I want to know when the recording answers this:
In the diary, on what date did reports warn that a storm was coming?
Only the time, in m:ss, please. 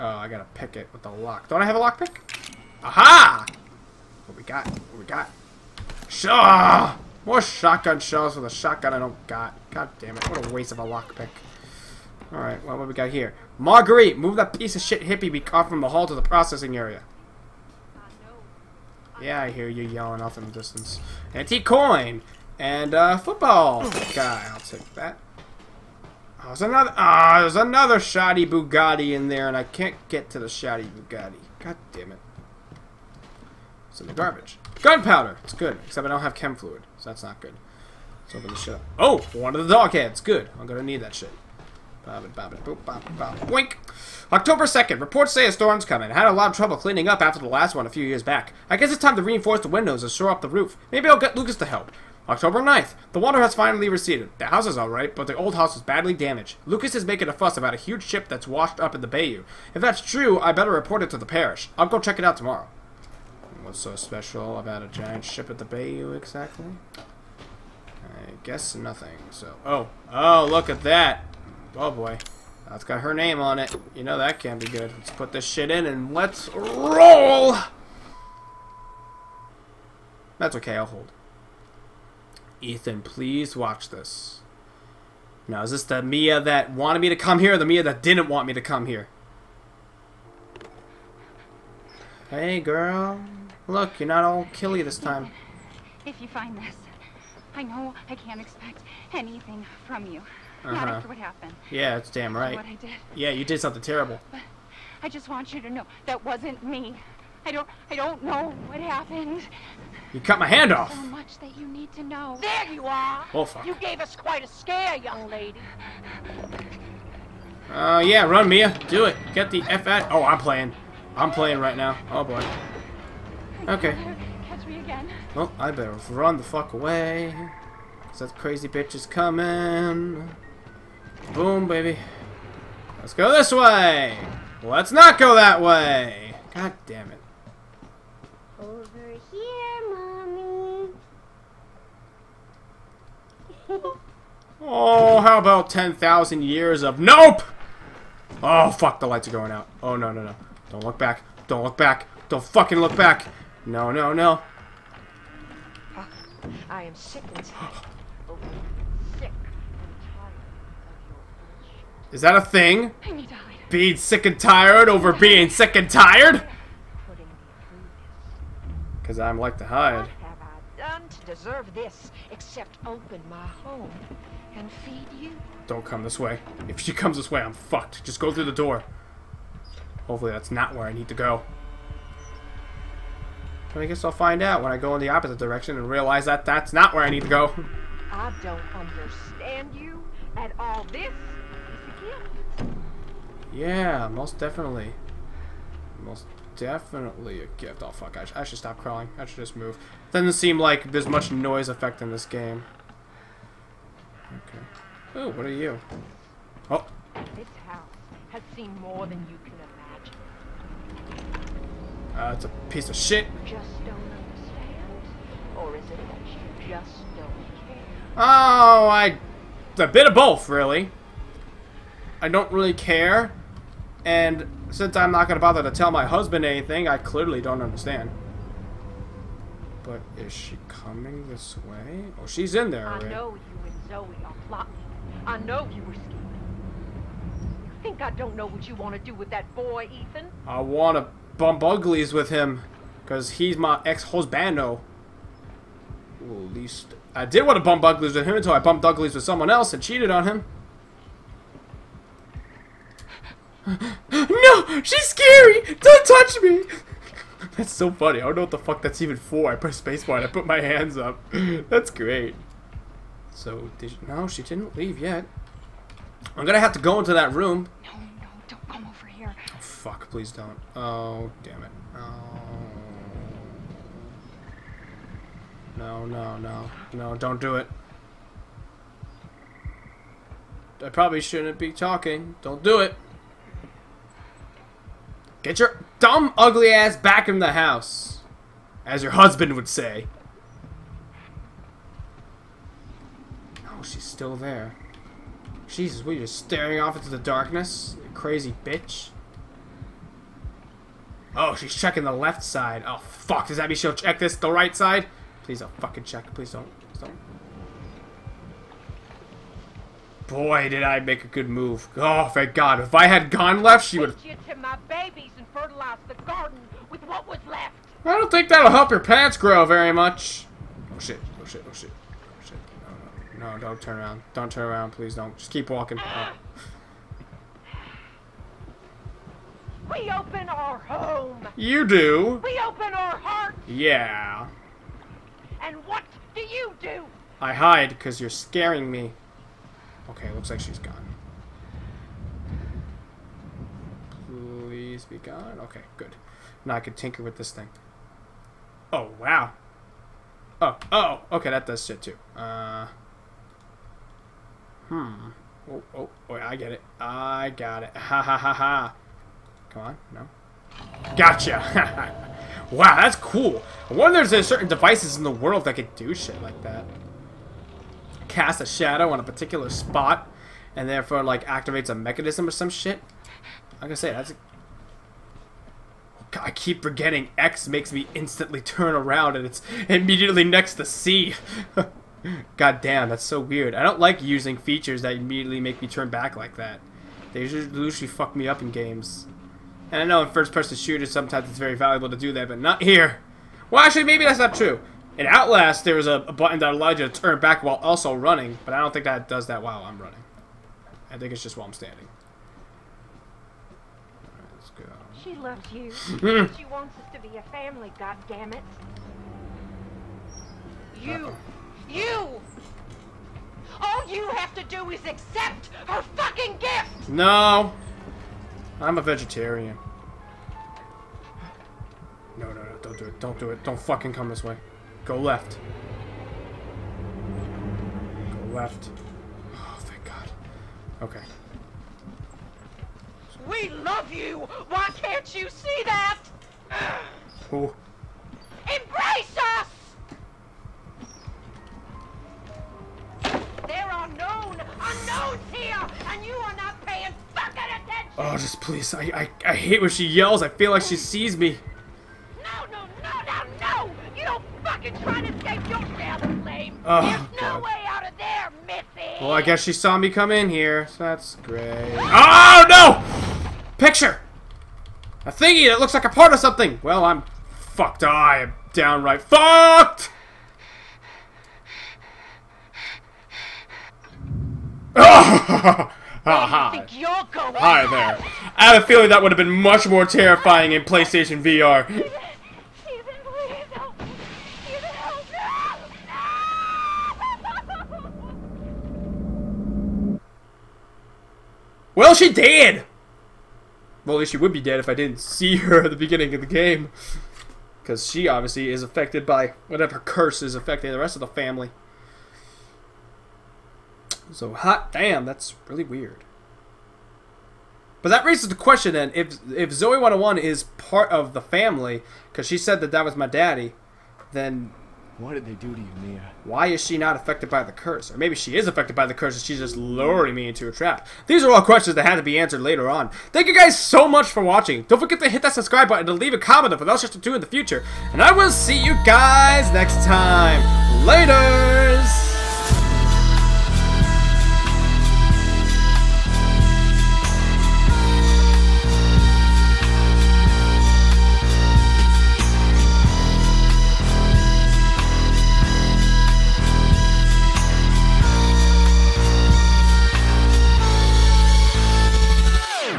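0:44.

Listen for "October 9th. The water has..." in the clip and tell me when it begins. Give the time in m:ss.
0:52.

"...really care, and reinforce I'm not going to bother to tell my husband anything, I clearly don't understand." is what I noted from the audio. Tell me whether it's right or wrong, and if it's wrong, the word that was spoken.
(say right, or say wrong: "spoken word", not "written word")
wrong: "since", not "reinforce".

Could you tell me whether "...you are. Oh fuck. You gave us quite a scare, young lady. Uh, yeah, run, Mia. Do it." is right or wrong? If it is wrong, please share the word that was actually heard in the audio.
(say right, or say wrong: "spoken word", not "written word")
right.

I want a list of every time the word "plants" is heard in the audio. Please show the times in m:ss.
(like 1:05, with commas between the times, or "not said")
5:18.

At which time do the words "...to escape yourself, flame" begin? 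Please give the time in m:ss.
7:35.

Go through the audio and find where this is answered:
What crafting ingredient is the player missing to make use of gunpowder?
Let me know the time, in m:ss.
0:36.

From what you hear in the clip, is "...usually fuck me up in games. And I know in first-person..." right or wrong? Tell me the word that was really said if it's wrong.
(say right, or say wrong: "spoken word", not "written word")
right.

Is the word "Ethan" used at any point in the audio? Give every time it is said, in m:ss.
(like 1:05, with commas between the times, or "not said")
1:22, 3:59.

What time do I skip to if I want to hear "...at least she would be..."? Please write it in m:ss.
8:14.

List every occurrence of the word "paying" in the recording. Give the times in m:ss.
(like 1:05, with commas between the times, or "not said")
7:26.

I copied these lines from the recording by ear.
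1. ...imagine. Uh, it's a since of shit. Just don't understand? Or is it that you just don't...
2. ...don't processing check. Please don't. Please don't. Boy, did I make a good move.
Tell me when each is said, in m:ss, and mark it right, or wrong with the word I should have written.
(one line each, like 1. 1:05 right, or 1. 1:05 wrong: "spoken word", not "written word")
1. 3:30 wrong: "piece", not "since"
2. 5:05 wrong: "fucking", not "processing".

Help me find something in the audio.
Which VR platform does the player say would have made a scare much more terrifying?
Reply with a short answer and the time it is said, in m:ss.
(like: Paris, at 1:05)
PlayStation VR, at 8:00.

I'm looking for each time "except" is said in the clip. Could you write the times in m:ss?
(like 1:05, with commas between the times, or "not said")
0:35, 2:52.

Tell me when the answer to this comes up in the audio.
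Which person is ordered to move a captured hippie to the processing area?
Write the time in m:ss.
0:13.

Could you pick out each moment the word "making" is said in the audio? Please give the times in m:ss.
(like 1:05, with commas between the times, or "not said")
0:57.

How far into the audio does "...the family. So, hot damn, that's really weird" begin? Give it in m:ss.
8:21.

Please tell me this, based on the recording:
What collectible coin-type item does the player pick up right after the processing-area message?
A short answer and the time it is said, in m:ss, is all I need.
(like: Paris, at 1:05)
Antique coin, at 0:21.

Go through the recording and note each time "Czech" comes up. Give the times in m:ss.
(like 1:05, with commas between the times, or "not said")
not said.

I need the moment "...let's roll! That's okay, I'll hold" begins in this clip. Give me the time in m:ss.
1:16.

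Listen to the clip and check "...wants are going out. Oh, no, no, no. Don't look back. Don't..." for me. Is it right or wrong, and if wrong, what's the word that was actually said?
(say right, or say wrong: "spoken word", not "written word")
wrong: "lights", not "wants".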